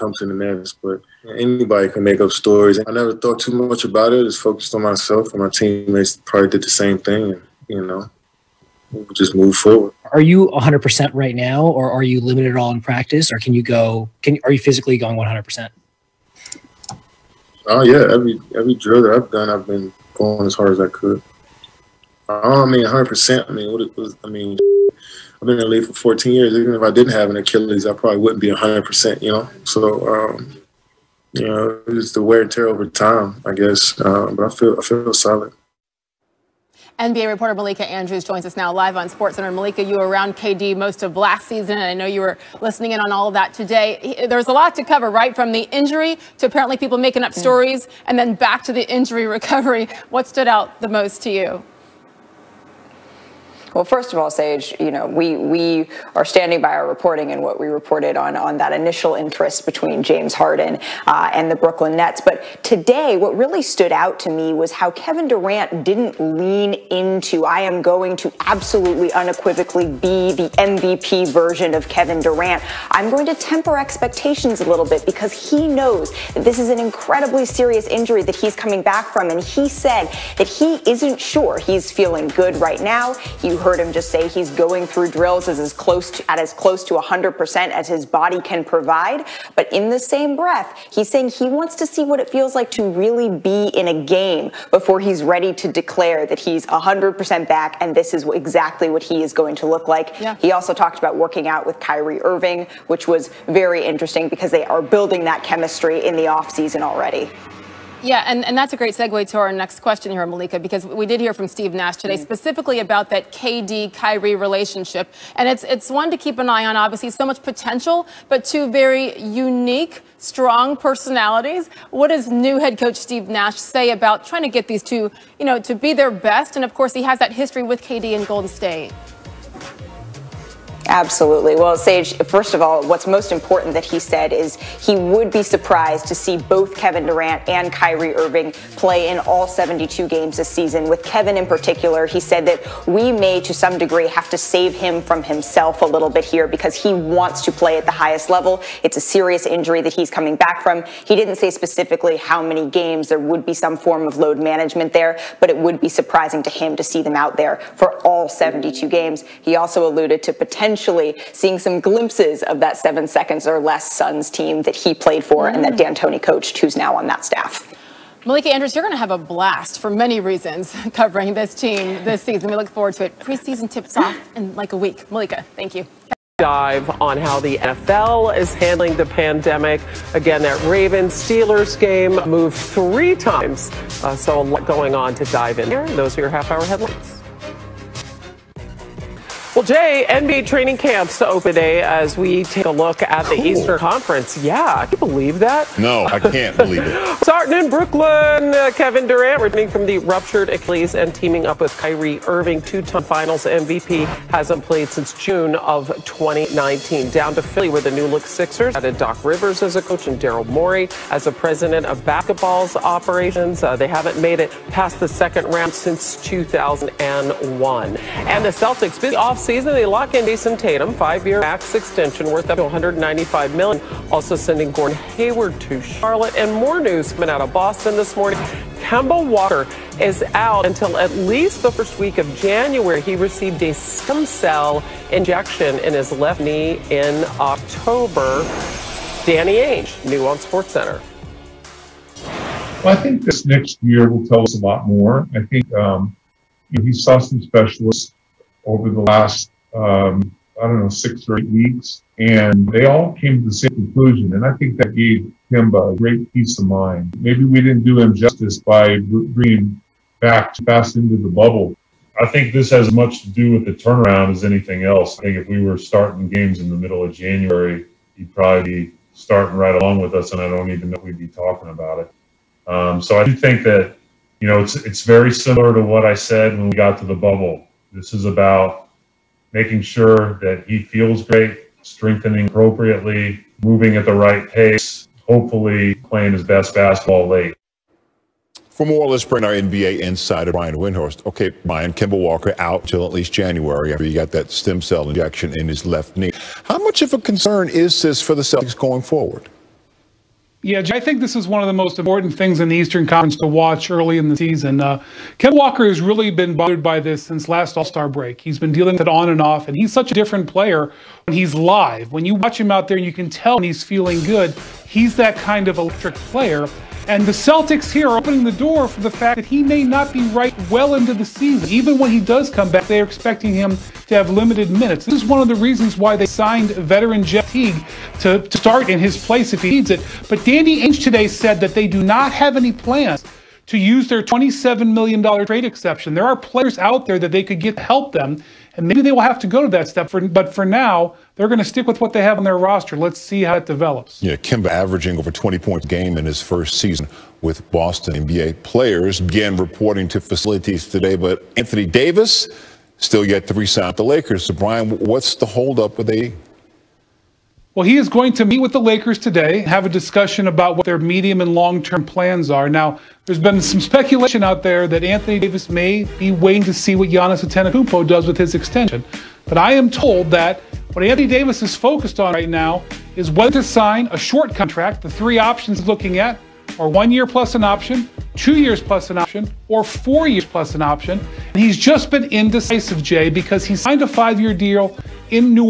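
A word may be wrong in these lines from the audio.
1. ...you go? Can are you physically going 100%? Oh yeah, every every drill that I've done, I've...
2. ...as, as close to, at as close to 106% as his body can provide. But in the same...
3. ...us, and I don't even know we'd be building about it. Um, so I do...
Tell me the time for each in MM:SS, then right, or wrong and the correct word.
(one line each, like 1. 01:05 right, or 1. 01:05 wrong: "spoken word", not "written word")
1. 00:13 right
2. 01:25 wrong: "100", not "106"
3. 04:30 wrong: "talking", not "building".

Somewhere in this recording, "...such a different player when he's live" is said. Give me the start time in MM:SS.
05:09.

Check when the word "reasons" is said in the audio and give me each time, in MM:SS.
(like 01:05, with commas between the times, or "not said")
02:50, 05:25.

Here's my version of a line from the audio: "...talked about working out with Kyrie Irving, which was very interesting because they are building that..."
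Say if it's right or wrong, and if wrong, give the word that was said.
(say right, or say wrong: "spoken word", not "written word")
right.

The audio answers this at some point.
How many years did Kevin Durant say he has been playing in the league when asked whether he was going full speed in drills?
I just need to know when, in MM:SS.
00:25.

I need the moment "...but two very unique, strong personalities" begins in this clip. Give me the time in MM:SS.
01:58.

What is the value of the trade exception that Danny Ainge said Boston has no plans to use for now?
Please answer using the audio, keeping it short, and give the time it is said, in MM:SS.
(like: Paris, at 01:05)
$27 million, at 05:34.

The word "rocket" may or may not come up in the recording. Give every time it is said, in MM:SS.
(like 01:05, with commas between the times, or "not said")
not said.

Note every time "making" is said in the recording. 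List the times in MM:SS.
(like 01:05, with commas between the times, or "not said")
00:46, 04:39.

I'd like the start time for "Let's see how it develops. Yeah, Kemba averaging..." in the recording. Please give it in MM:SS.
05:42.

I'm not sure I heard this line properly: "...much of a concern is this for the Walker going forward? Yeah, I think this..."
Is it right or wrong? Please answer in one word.
wrong.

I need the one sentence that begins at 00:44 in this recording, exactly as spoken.
There's a lot to cover, right?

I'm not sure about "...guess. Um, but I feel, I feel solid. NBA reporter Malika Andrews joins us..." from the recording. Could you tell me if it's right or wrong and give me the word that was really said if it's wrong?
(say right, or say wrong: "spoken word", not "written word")
right.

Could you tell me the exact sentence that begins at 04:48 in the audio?
For more, let's bring our NBA insider, Brian Windhorst.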